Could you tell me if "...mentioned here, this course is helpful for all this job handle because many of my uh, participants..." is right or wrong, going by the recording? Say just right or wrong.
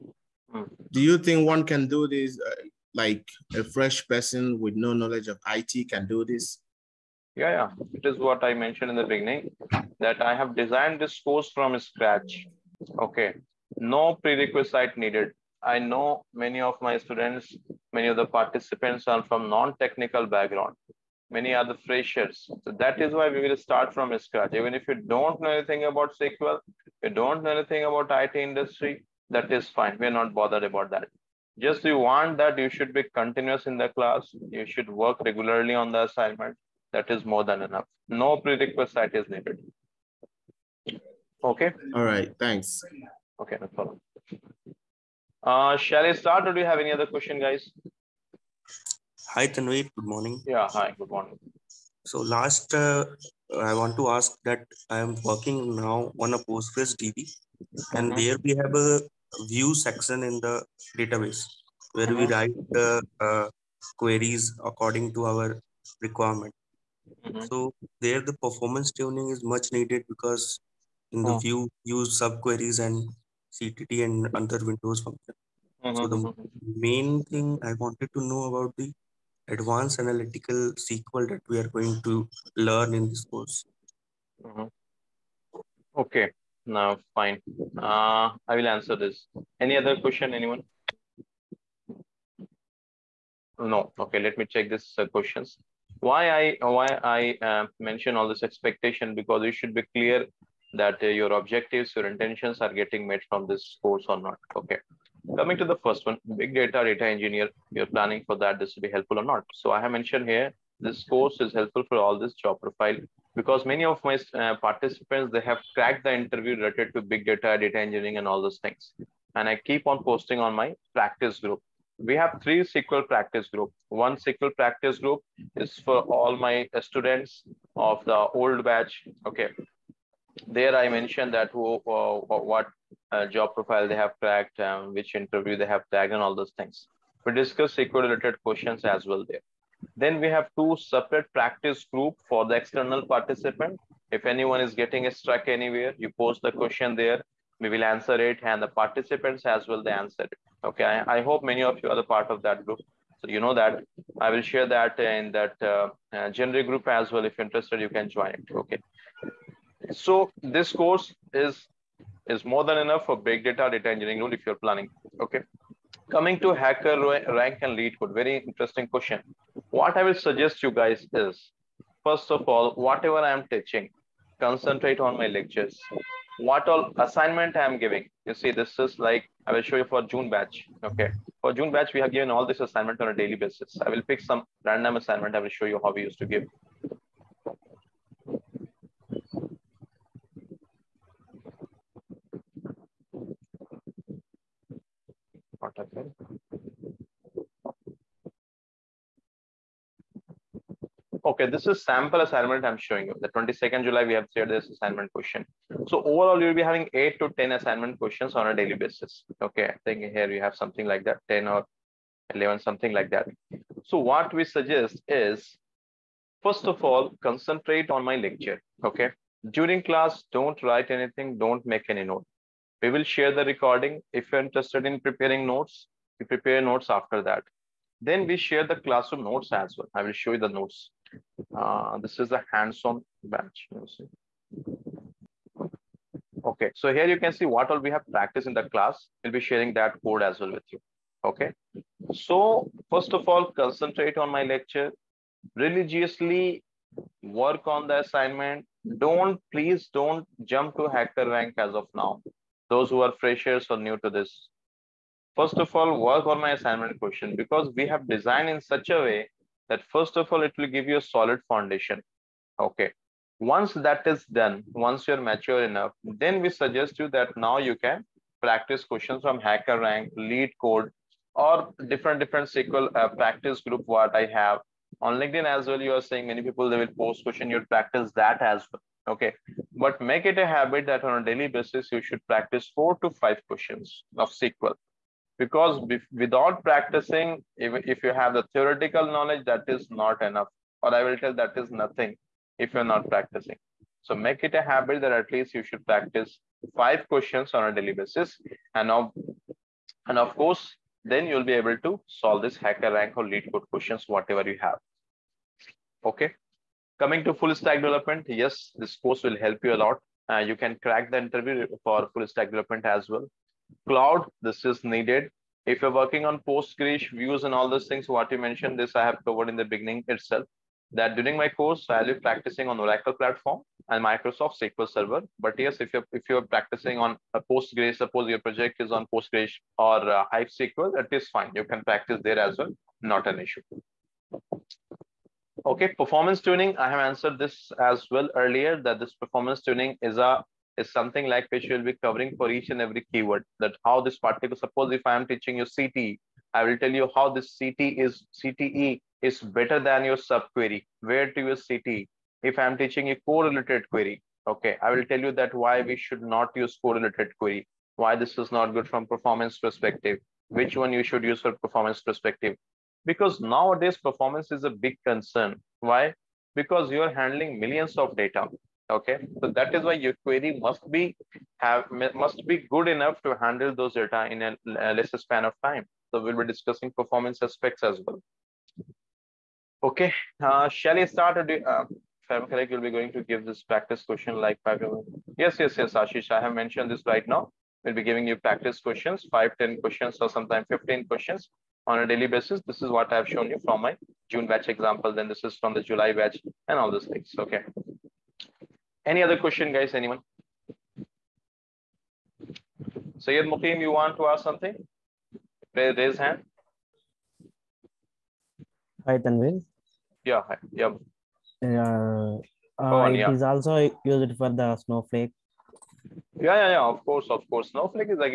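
wrong.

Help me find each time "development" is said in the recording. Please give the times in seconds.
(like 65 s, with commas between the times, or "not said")
307 s, 312 s.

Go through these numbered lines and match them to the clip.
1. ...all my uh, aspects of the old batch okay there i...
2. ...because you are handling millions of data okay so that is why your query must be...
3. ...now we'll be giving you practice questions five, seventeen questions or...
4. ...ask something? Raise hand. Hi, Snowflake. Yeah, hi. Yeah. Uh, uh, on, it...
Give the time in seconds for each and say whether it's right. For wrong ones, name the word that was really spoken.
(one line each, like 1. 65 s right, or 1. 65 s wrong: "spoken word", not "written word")
1. 126 s wrong: "students", not "aspects"
2. 366 s right
3. 387 s wrong: "ten", not "seventeen"
4. 404 s wrong: "Tanvir", not "Snowflake".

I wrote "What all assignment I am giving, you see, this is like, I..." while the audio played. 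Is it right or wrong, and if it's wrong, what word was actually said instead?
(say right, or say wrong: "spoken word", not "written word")
right.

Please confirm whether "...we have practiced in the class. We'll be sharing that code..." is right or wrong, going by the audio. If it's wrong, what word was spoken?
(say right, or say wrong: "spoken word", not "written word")
right.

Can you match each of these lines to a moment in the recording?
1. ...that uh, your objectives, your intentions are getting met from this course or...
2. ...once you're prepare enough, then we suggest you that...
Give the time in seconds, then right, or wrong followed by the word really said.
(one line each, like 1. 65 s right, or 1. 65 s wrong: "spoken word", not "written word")
1. 100 s right
2. 264 s wrong: "mature", not "prepare".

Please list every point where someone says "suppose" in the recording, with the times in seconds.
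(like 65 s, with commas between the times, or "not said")
327 s, 344 s.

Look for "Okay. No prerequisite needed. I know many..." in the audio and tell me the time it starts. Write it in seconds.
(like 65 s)
12 s.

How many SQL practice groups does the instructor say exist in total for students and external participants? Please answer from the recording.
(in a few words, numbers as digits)
3.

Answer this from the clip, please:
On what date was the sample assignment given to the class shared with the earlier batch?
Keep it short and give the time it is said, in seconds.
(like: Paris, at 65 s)
22nd July, at 203 s.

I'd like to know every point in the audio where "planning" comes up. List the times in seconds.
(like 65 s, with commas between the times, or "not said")
107 s, 164 s.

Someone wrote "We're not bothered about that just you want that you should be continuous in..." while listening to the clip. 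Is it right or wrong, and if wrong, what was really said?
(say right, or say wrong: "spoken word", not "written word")
right.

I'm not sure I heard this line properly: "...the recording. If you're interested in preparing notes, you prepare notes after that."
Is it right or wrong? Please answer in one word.
right.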